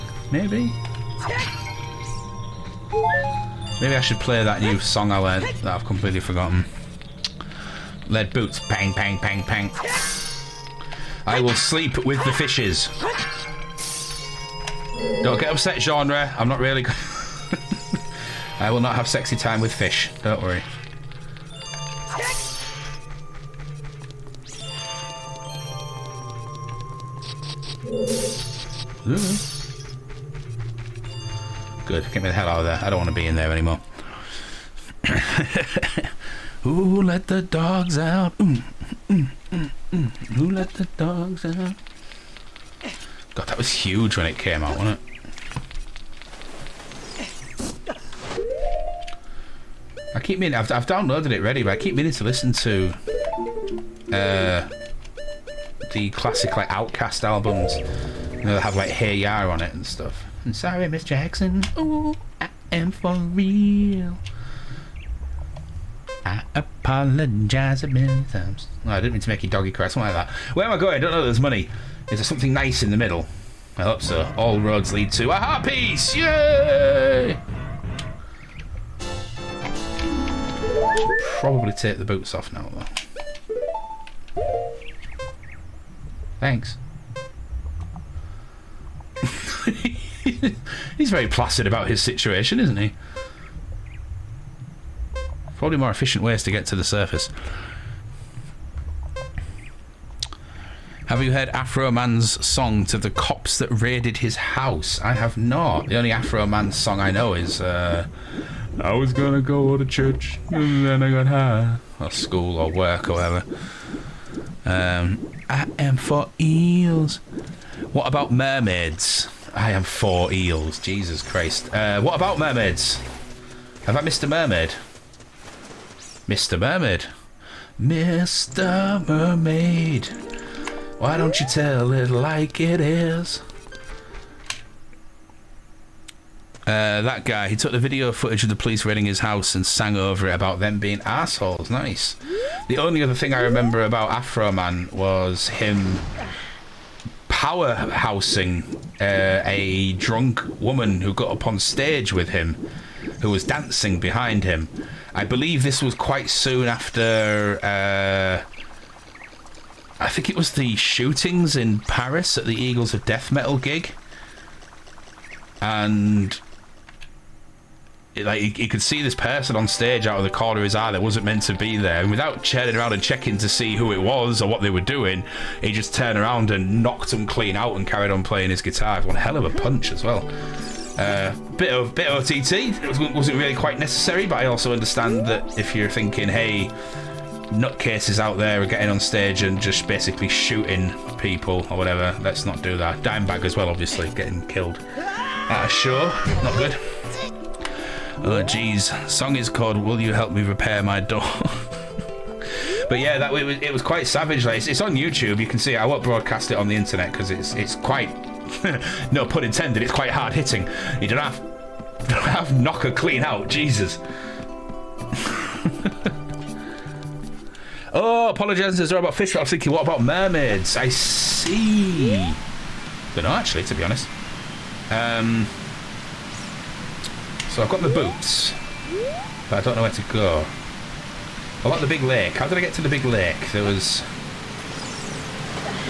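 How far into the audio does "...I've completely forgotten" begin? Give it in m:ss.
0:05.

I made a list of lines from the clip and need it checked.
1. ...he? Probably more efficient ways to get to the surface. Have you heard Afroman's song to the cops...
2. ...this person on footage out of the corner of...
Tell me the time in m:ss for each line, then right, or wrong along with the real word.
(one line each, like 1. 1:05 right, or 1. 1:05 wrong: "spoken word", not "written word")
1. 1:32 right
2. 2:49 wrong: "stage", not "footage".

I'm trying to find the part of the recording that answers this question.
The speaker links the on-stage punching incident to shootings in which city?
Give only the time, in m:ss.
2:41.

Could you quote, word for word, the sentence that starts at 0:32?
I don't want to be in there anymore.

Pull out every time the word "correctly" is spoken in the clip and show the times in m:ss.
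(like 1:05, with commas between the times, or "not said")
not said.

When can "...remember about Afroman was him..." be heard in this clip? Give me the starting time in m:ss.
2:23.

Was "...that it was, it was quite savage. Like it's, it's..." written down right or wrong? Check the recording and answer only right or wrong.
right.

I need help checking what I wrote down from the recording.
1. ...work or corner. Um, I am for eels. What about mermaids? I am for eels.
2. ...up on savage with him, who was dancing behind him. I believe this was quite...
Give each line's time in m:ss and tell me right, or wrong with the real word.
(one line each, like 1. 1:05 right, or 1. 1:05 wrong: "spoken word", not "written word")
1. 1:52 wrong: "whatever", not "corner"
2. 2:31 wrong: "stage", not "savage".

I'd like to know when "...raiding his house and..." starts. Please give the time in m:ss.
2:18.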